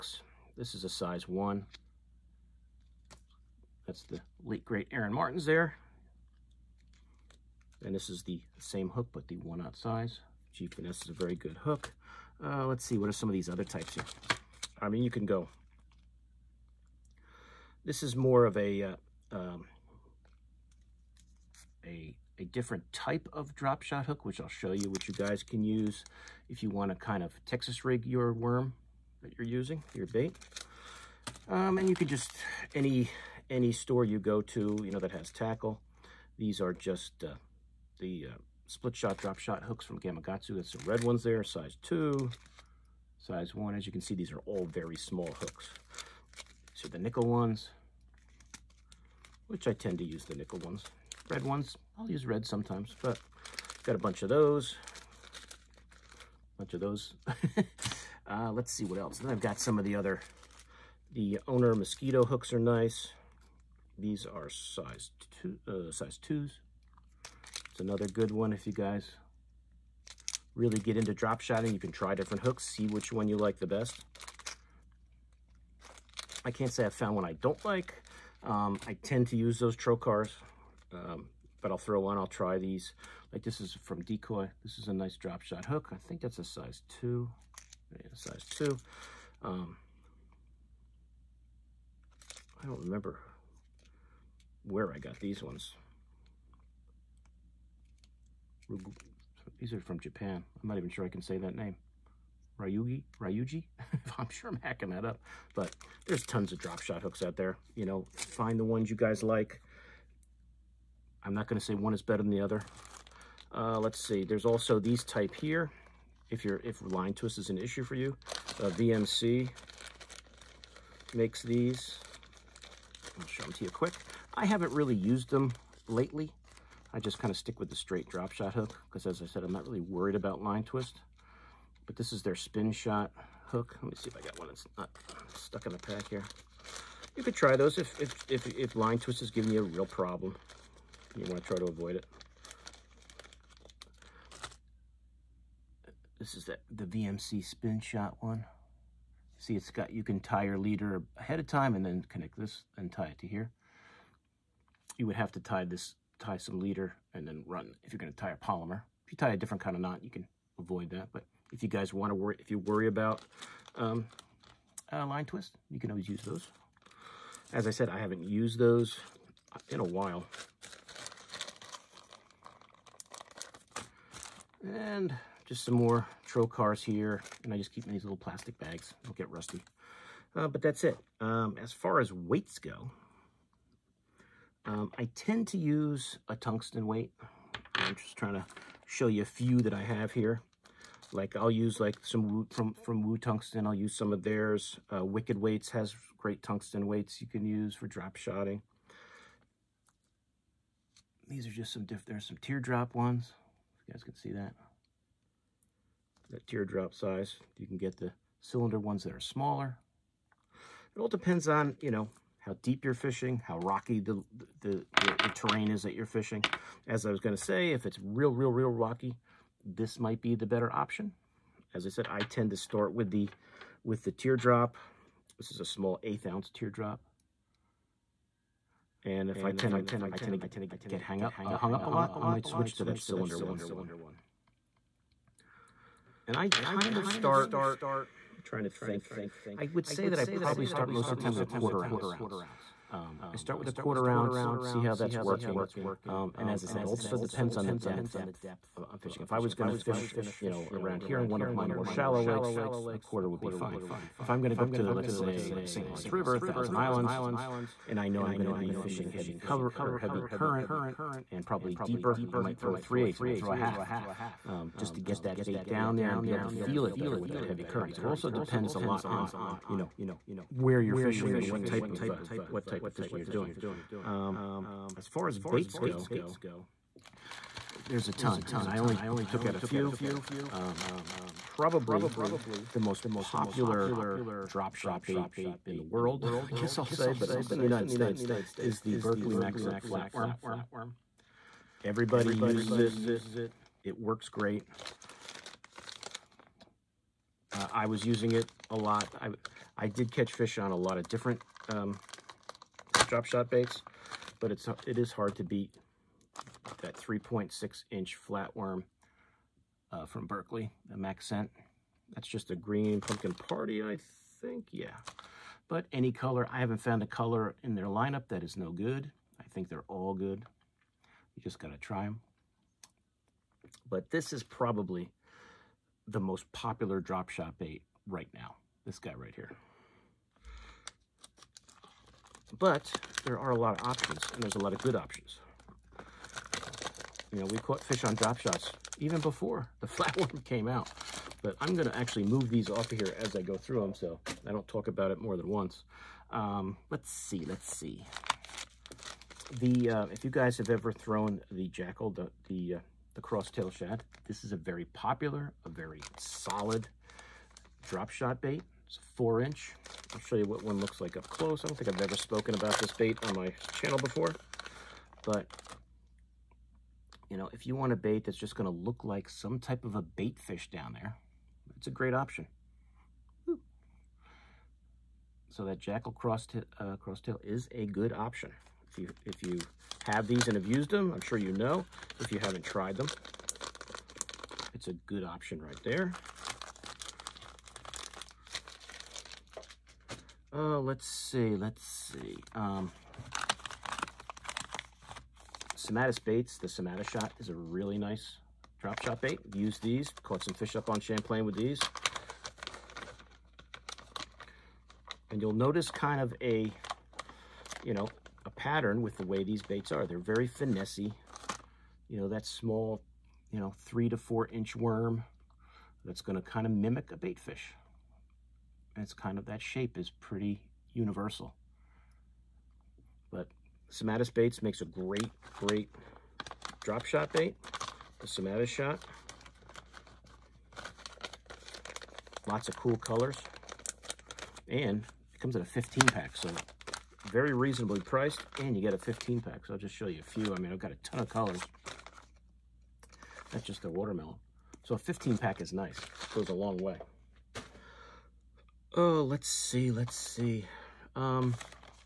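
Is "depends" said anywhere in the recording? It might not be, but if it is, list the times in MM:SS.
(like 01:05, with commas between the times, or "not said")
03:31, 04:07, 04:28.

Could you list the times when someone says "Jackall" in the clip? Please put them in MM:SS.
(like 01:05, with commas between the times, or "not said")
05:51, 06:15.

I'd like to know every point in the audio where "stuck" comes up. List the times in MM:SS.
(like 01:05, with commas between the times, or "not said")
02:15.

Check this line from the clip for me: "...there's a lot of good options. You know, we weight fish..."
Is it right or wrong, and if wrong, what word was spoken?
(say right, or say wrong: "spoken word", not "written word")
wrong: "caught", not "weight".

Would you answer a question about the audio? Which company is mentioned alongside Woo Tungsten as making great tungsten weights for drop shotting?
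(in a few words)
Wicked Weights.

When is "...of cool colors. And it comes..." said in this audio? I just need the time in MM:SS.
07:12.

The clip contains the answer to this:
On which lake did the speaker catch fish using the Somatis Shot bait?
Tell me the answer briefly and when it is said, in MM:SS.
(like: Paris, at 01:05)
Champlain, at 06:40.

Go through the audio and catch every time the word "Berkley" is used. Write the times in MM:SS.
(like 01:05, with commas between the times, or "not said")
04:48, 05:10.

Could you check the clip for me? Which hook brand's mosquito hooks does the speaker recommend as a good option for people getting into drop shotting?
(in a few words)
Owner.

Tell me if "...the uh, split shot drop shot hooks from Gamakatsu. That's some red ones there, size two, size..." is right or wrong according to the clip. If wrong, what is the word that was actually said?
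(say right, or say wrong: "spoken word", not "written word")
right.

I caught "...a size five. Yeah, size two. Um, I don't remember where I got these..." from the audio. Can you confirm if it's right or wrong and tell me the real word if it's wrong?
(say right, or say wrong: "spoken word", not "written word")
wrong: "two", not "five".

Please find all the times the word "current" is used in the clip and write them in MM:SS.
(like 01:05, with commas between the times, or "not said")
04:20, 04:27.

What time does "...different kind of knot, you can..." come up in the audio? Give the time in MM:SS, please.
02:39.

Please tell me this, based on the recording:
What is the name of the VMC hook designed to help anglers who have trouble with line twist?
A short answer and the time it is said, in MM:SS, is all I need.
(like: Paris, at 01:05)
spin shot hook, at 02:12.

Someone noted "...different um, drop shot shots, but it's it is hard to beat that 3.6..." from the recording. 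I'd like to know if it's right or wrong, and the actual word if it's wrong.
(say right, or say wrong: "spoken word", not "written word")
wrong: "baits", not "shots".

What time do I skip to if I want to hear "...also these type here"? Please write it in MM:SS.
01:54.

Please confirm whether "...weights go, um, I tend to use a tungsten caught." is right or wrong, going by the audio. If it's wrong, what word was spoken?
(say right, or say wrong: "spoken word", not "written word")
wrong: "weight", not "caught".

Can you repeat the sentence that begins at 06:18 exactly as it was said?
If you, if you have these and have used them, I'm sure you know.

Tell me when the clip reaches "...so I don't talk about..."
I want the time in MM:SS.
05:43.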